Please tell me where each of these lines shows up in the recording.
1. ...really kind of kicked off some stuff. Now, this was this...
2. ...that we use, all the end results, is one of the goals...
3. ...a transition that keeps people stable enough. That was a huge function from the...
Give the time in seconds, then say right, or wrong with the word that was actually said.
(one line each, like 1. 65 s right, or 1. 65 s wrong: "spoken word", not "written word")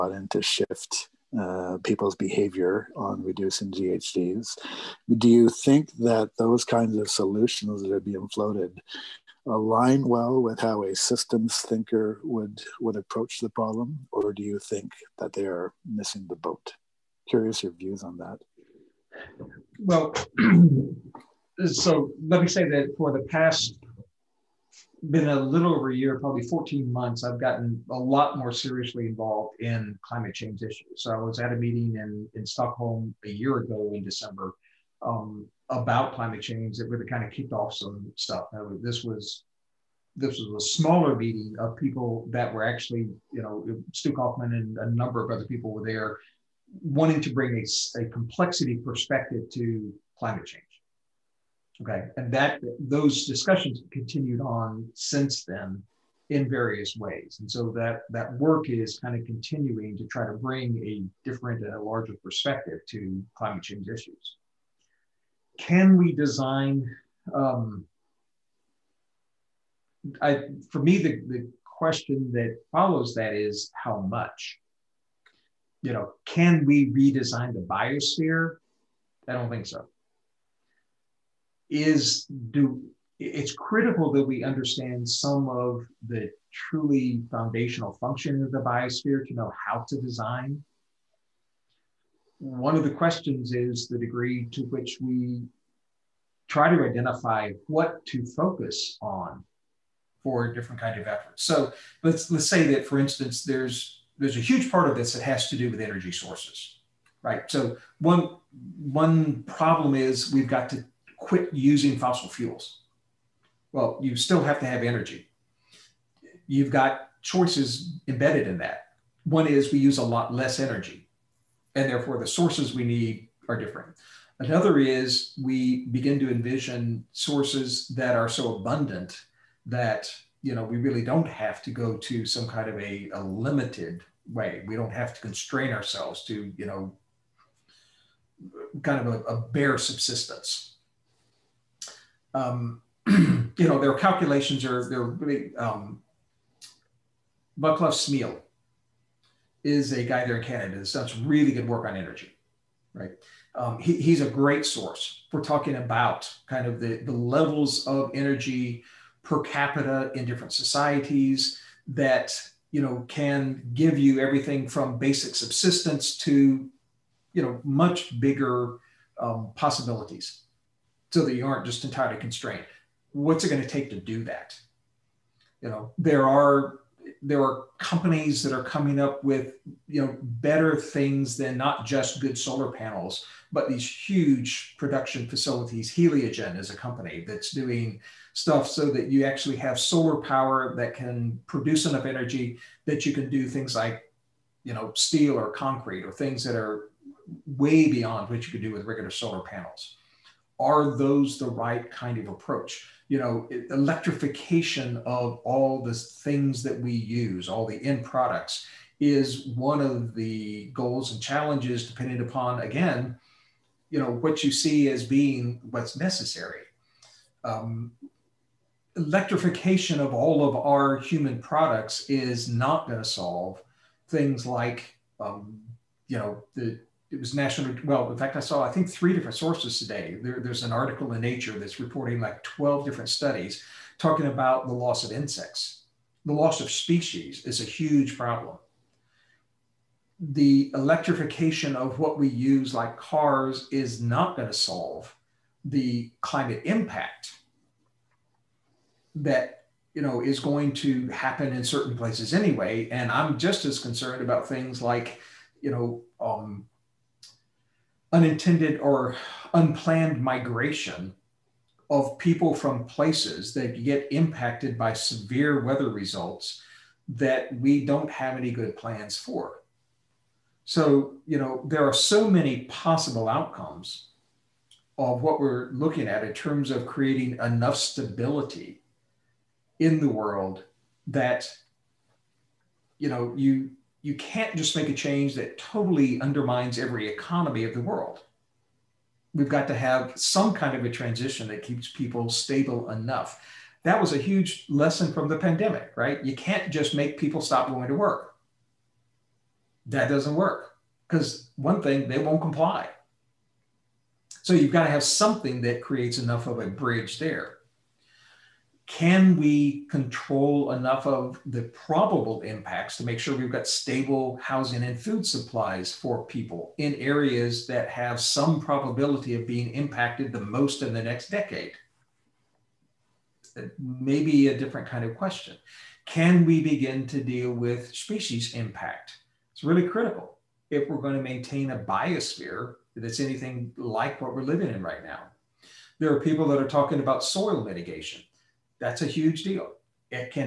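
1. 36 s right
2. 206 s wrong: "products", not "results"
3. 290 s wrong: "lesson", not "function".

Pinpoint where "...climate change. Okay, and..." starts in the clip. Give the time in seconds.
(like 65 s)
50 s.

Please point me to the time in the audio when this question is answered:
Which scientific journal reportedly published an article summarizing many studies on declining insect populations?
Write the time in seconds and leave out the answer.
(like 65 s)
231 s.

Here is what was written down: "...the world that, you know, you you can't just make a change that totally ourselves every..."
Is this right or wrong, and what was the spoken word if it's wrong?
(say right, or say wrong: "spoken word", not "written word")
wrong: "undermines", not "ourselves".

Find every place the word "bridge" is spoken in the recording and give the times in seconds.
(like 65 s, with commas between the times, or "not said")
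306 s.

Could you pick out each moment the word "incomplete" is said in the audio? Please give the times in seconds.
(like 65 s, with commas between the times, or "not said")
not said.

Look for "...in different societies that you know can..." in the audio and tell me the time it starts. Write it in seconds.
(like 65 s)
160 s.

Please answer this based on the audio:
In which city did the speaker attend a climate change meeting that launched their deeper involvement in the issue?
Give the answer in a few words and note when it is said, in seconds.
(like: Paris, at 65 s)
Stockholm, at 32 s.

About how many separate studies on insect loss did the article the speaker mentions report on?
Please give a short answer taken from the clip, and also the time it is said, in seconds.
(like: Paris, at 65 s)
12, at 232 s.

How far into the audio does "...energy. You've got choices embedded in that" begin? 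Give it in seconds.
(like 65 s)
114 s.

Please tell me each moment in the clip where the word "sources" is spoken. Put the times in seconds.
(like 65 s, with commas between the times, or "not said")
106 s, 122 s, 127 s, 154 s, 229 s.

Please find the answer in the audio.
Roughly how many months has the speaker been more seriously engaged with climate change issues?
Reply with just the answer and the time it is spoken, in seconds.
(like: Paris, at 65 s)
14 months, at 26 s.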